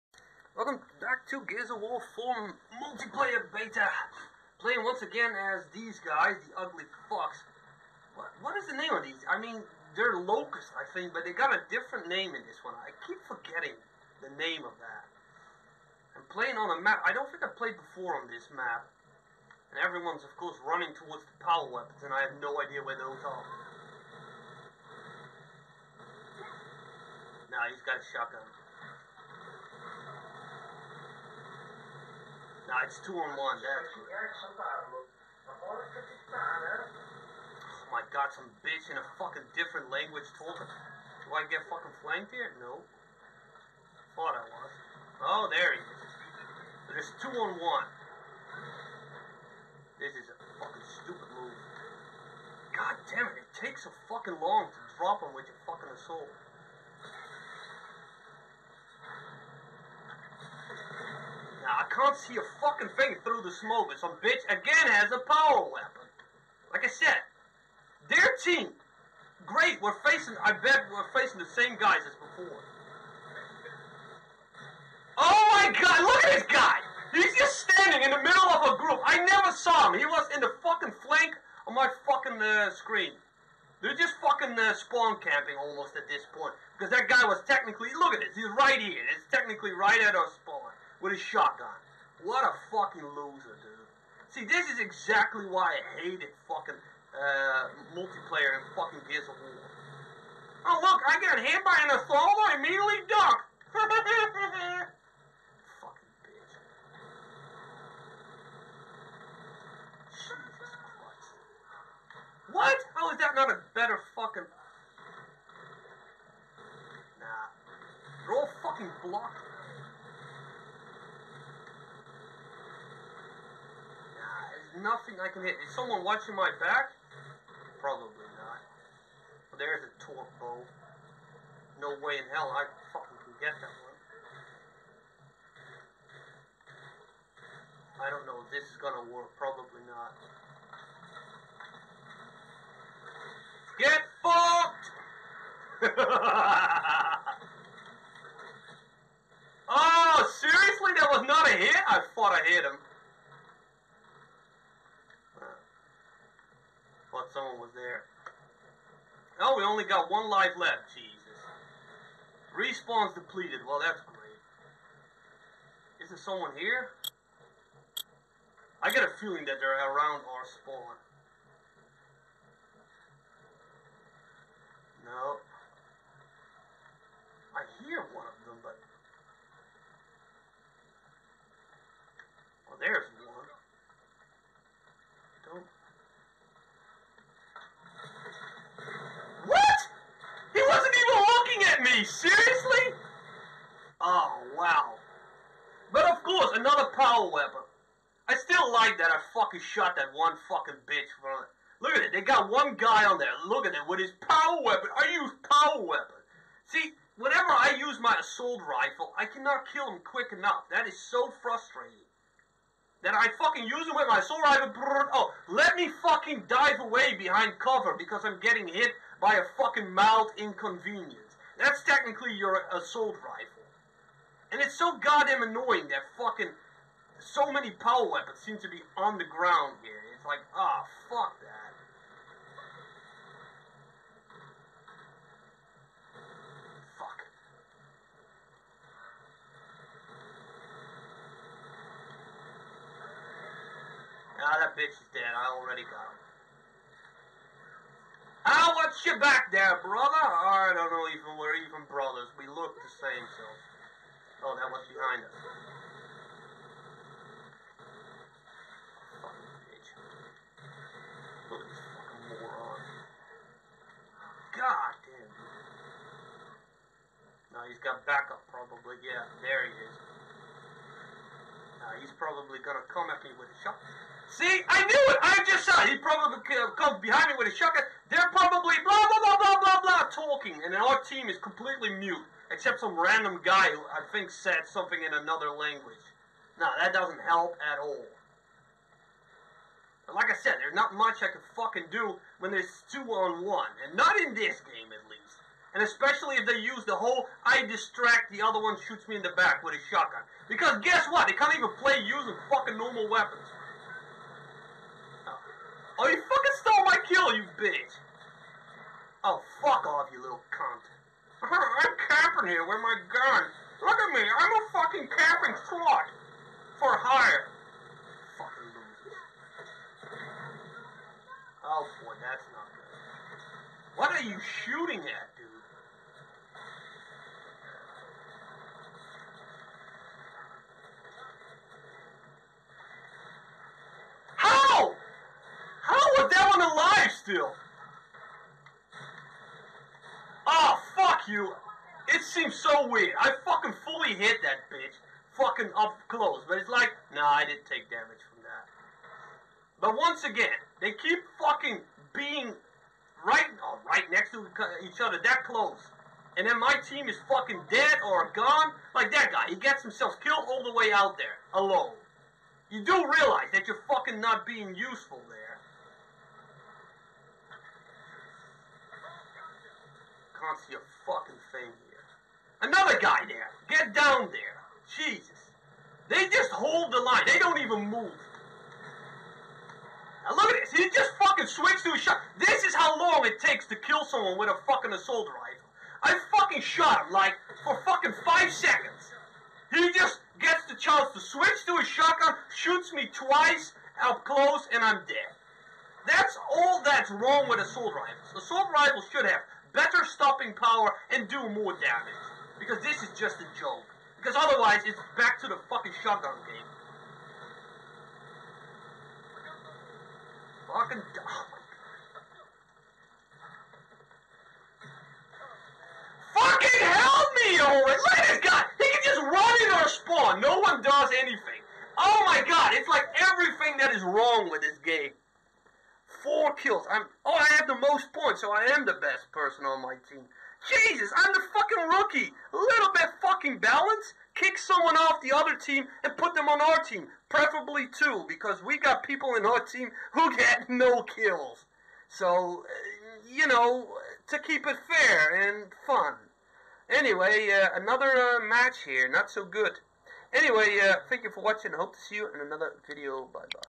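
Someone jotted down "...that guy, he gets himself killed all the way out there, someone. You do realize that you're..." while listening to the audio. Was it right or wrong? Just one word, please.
wrong.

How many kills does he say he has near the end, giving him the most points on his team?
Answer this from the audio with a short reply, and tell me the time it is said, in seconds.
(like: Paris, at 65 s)
4, at 426 s.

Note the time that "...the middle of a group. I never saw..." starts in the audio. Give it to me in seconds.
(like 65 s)
78 s.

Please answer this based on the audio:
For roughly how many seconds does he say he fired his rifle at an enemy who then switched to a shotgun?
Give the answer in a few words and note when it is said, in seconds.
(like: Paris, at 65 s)
5, at 388 s.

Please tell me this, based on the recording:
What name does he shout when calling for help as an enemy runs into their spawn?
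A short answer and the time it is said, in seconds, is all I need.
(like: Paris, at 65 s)
Owen, at 417 s.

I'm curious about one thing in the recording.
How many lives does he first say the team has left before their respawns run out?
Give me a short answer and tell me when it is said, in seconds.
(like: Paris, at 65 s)
1, at 160 s.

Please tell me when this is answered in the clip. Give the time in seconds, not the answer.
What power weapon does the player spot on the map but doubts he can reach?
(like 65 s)
129 s.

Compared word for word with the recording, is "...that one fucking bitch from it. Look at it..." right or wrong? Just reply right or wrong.
right.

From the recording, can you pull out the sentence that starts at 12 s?
I keep forgetting the name of that.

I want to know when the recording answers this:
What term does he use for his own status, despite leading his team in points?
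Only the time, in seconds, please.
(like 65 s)
431 s.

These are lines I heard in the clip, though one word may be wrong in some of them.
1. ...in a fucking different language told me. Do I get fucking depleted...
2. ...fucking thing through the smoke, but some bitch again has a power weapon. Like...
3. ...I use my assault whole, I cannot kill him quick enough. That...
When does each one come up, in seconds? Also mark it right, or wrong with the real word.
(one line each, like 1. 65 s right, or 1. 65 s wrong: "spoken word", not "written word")
1. 38 s wrong: "flanked", not "depleted"
2. 62 s right
3. 207 s wrong: "rifle", not "whole".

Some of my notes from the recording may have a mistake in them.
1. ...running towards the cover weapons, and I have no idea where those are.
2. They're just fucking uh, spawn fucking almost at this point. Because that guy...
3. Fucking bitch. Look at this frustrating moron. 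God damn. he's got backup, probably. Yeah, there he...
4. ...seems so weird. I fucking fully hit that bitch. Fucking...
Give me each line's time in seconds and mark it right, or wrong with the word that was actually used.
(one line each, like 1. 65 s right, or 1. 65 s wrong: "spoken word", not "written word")
1. 20 s wrong: "power", not "cover"
2. 83 s wrong: "camping", not "fucking"
3. 259 s wrong: "fucking", not "frustrating"
4. 342 s right.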